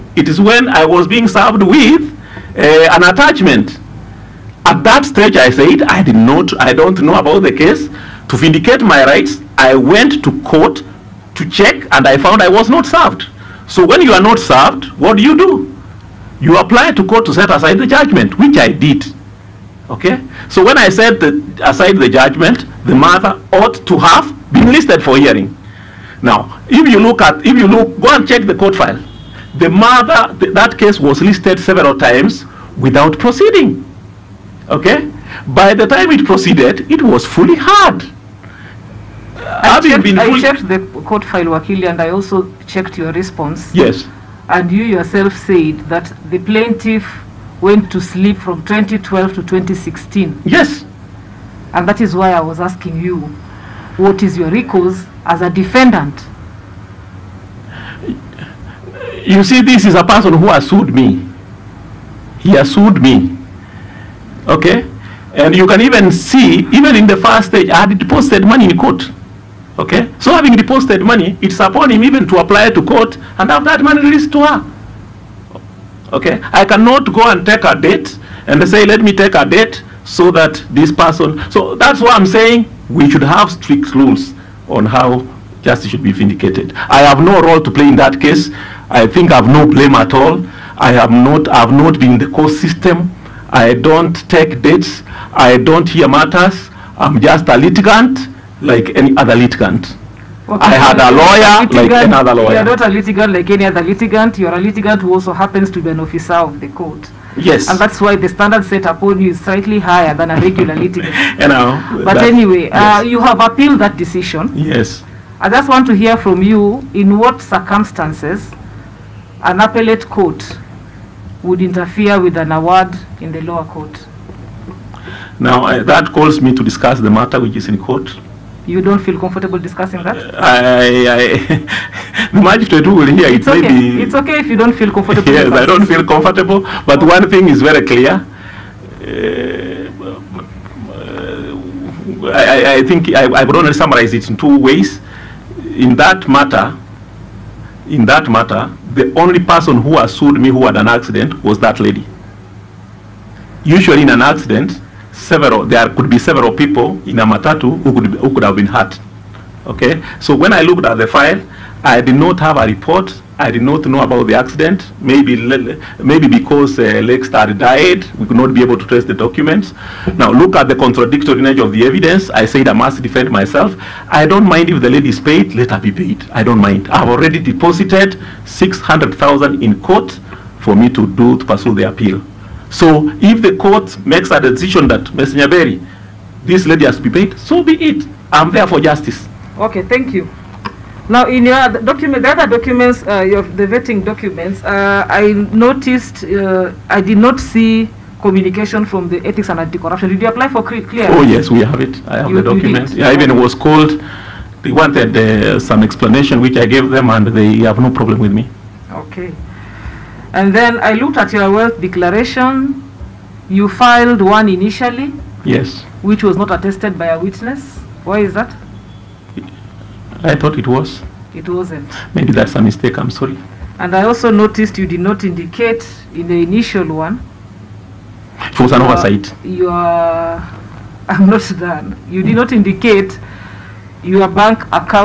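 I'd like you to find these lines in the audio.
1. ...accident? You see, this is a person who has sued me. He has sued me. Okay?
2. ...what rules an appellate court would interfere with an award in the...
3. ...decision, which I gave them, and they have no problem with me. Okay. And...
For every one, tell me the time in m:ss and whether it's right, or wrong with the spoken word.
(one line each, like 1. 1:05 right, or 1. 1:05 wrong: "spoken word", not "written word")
1. 0:55 wrong: "defendant", not "accident"
2. 1:57 wrong: "circumstances", not "rules"
3. 3:25 wrong: "explanation", not "decision".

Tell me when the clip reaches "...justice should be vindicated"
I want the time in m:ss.
1:25.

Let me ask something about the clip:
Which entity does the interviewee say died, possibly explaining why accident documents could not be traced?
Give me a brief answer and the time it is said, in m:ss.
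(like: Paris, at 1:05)
Lake Star, at 2:47.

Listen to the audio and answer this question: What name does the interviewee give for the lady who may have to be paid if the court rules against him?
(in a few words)
Ms. Nyaberi.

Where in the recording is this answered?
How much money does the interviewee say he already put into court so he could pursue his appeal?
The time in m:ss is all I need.
2:58.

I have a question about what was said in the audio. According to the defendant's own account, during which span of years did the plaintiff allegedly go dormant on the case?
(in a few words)
2012 to 2016.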